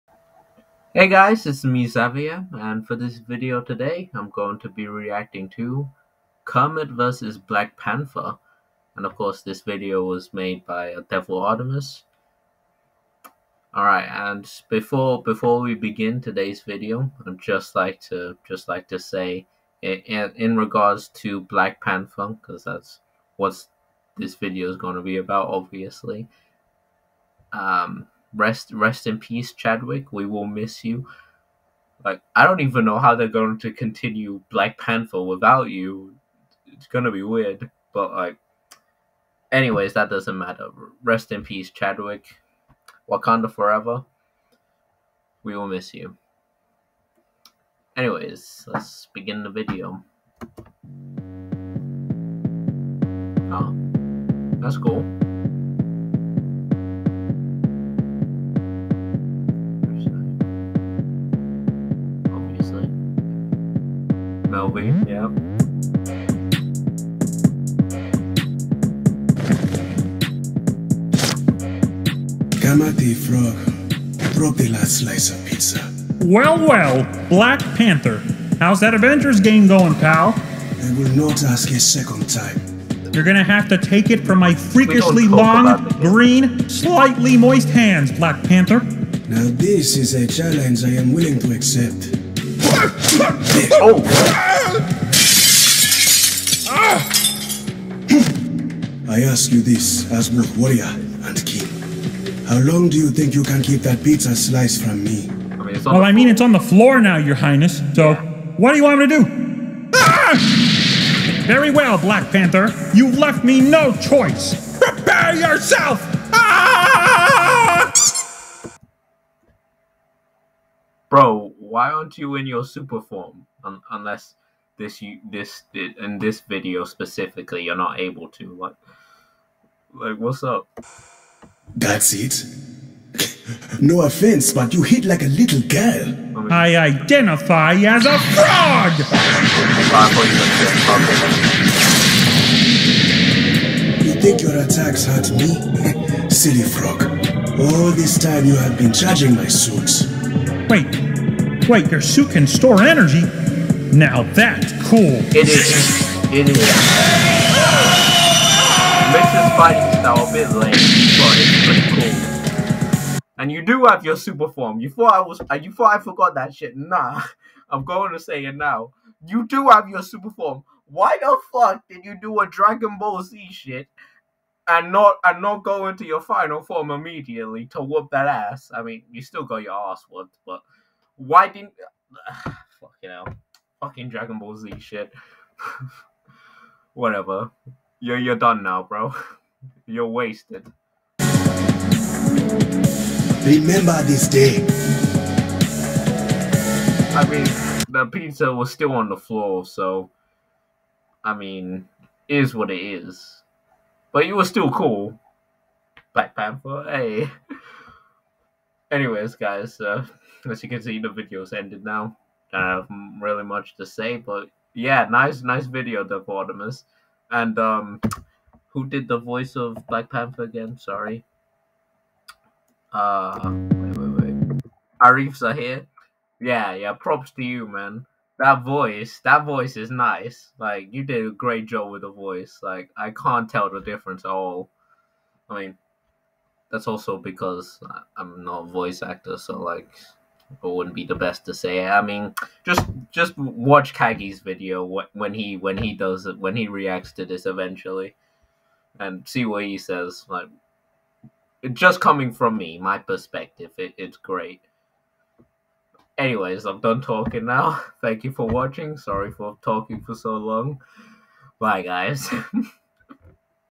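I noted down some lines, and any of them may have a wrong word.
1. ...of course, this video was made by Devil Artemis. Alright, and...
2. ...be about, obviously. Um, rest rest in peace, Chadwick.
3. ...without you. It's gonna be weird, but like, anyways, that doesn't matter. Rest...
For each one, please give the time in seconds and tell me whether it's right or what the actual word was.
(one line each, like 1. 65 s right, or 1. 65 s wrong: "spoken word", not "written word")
1. 9 s right
2. 25 s right
3. 35 s right.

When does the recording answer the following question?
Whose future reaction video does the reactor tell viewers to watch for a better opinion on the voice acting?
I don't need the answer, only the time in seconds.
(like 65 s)
243 s.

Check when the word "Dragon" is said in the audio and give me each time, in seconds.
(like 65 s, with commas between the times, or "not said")
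172 s, 184 s.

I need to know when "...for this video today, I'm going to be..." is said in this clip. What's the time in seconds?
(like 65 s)
2 s.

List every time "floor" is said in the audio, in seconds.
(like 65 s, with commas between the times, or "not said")
106 s, 199 s.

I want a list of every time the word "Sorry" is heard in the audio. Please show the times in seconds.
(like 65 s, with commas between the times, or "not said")
220 s, 258 s.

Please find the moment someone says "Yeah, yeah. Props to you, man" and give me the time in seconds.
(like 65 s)
226 s.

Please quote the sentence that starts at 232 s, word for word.
Like I can't tell the difference at all.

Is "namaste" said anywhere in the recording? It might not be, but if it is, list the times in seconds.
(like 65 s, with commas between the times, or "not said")
not said.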